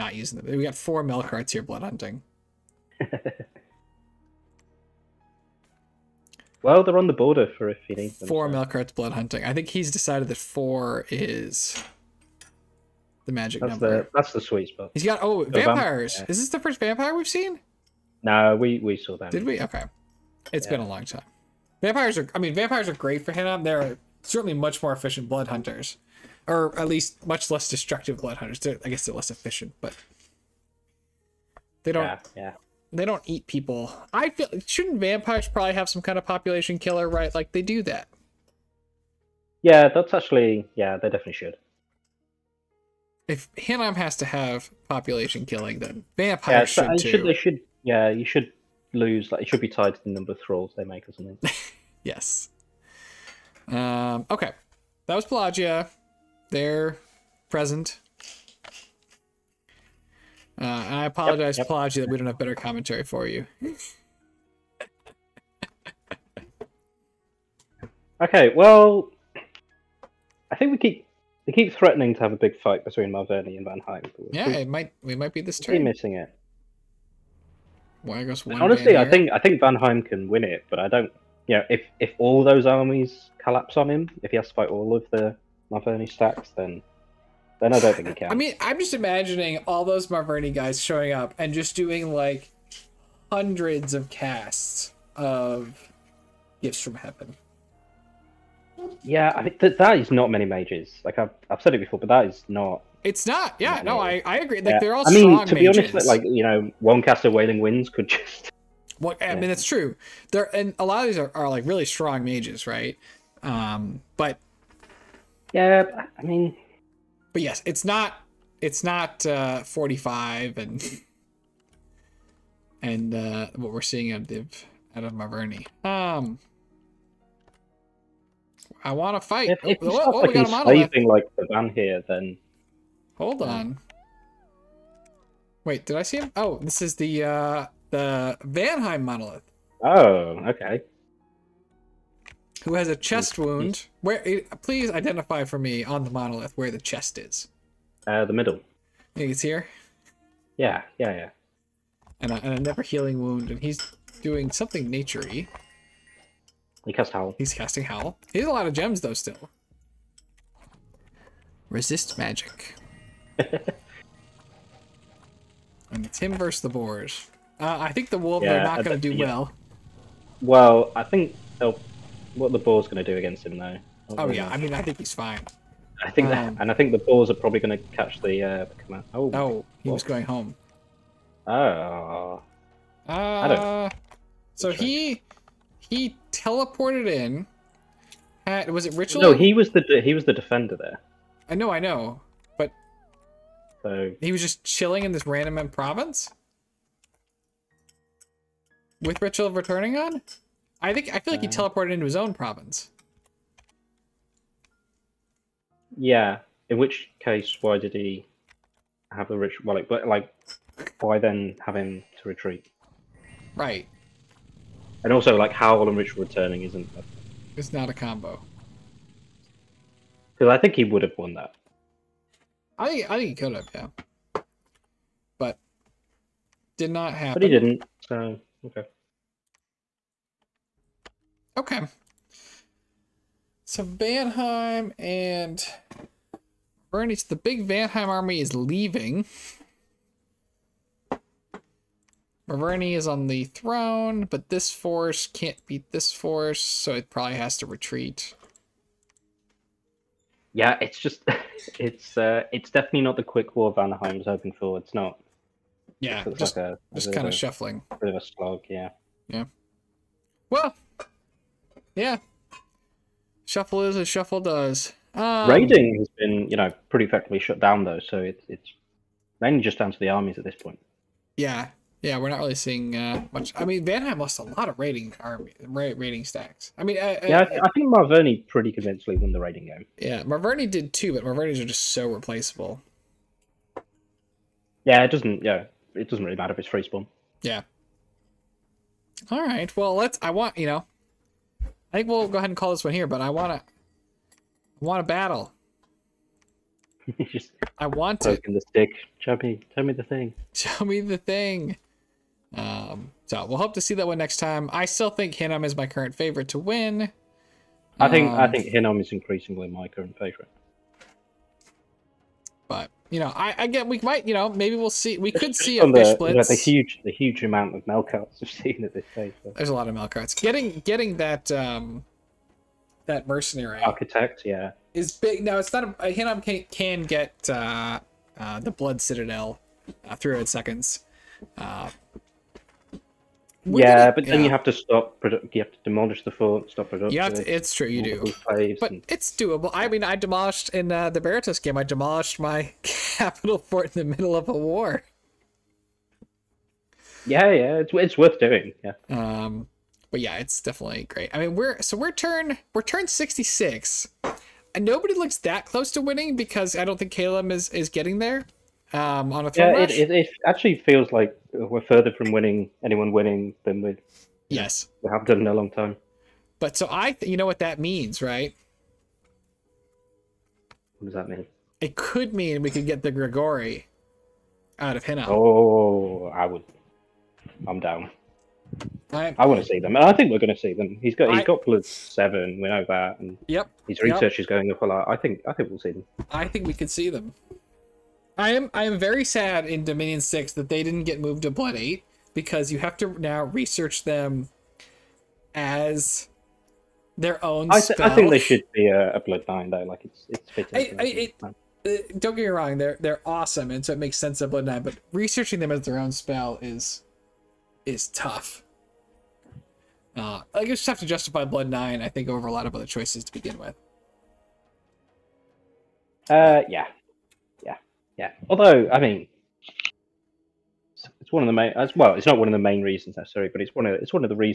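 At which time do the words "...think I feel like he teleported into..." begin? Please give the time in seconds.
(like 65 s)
200 s.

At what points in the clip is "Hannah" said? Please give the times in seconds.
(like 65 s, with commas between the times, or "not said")
23 s.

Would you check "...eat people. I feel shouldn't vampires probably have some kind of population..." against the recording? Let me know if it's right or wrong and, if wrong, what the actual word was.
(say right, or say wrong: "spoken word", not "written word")
right.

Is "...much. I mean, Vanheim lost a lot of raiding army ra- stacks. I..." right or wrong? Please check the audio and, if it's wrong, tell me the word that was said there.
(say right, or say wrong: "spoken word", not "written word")
right.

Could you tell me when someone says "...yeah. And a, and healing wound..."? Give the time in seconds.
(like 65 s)
151 s.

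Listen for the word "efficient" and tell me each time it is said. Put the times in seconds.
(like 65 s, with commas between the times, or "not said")
24 s, 29 s.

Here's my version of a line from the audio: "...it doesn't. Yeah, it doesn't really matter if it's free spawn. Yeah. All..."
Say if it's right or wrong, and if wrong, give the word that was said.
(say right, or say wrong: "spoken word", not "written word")
right.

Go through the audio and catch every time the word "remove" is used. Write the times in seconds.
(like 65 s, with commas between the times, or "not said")
not said.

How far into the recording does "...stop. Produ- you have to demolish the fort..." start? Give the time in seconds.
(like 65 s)
334 s.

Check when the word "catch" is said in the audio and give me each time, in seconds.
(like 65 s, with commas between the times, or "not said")
177 s.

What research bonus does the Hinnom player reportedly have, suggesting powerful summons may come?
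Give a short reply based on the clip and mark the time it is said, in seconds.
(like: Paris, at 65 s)
+7, at 381 s.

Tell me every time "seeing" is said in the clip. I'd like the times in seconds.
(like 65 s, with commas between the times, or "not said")
123 s, 272 s.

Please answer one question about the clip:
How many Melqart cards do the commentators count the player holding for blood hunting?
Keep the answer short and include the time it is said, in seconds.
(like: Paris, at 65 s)
4, at 8 s.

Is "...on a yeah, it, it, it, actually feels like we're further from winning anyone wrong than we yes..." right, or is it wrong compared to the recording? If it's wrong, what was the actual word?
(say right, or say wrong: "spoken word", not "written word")
wrong: "winning", not "wrong".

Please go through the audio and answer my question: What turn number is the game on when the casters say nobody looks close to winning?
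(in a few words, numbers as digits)
66.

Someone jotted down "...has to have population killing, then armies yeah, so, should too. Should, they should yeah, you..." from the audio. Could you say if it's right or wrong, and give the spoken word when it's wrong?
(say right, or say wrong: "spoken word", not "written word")
wrong: "vampires", not "armies".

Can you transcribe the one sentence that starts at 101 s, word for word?
Like I've, I've said it before, but that is not.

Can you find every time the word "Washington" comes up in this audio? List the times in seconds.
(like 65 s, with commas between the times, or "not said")
not said.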